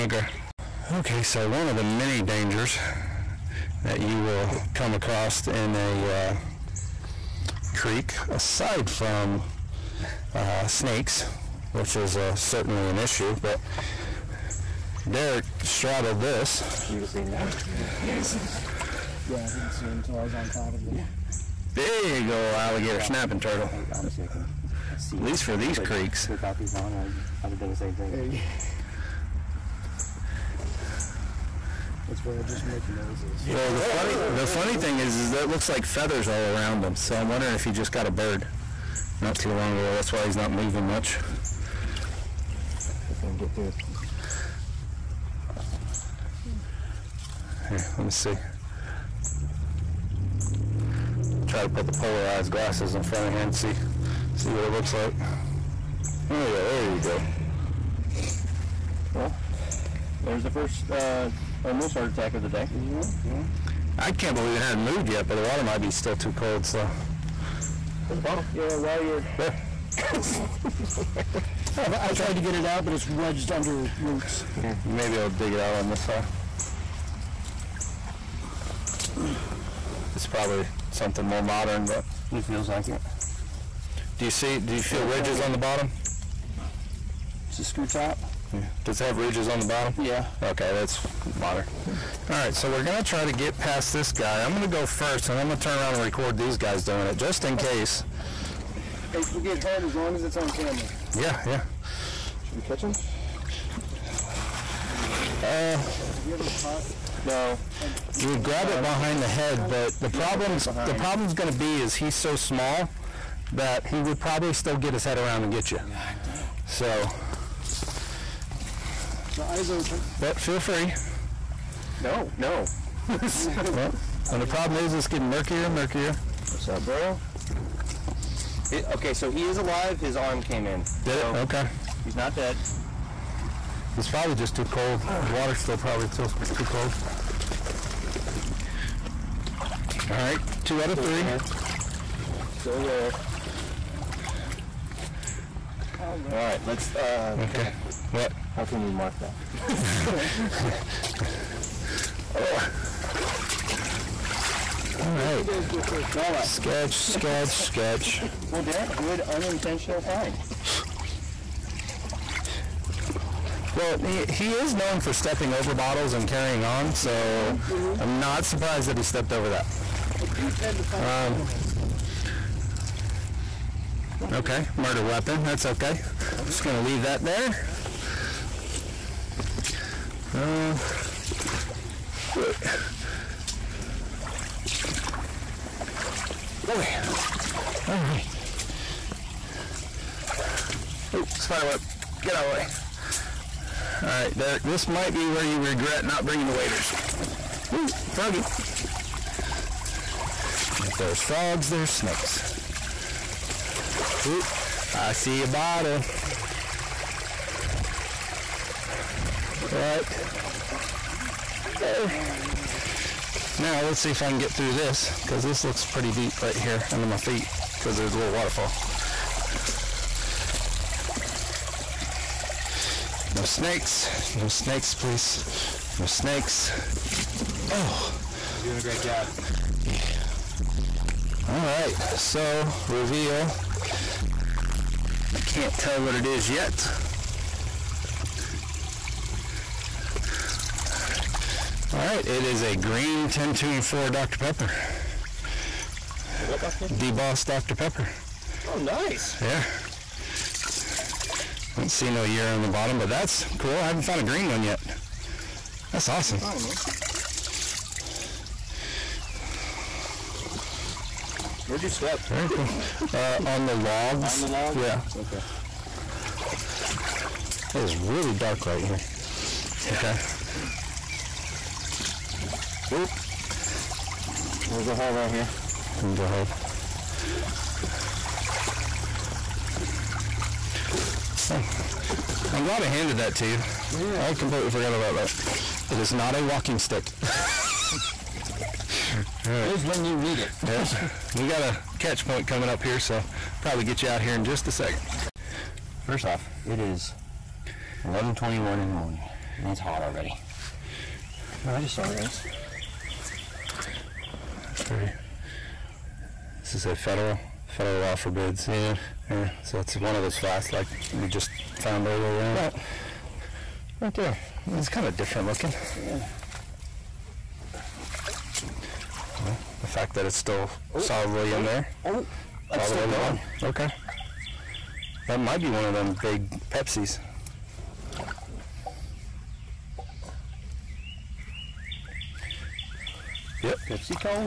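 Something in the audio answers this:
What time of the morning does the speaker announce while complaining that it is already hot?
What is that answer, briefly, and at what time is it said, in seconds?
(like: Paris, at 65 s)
11:21, at 298 s.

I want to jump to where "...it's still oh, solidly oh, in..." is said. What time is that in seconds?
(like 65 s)
320 s.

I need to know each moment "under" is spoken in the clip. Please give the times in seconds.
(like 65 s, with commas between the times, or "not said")
73 s, 216 s.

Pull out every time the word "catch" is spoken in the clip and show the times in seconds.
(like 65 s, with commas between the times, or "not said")
102 s, 291 s.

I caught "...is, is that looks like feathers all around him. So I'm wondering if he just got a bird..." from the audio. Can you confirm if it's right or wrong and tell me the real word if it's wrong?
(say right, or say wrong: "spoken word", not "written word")
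right.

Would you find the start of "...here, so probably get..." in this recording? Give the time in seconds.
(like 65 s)
292 s.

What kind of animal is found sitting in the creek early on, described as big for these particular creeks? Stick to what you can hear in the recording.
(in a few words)
Alligator snapping turtle.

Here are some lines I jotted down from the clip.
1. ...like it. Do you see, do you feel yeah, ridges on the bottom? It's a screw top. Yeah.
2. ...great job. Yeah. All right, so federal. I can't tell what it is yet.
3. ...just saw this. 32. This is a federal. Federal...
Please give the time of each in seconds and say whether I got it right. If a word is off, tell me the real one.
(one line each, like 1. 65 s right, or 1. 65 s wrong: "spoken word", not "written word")
1. 82 s right
2. 228 s wrong: "reveal", not "federal"
3. 301 s wrong: "30", not "32".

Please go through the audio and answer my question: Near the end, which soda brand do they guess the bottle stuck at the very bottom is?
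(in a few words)
Pepsi.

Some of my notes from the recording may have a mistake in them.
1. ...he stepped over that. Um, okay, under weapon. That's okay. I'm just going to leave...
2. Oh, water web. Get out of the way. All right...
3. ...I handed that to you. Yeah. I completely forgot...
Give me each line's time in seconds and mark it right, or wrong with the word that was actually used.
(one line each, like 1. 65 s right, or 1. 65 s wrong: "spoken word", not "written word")
1. 168 s wrong: "murder", not "under"
2. 191 s wrong: "spider", not "water"
3. 282 s right.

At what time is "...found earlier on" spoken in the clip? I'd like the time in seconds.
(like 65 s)
311 s.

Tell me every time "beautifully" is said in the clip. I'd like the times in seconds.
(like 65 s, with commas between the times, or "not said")
not said.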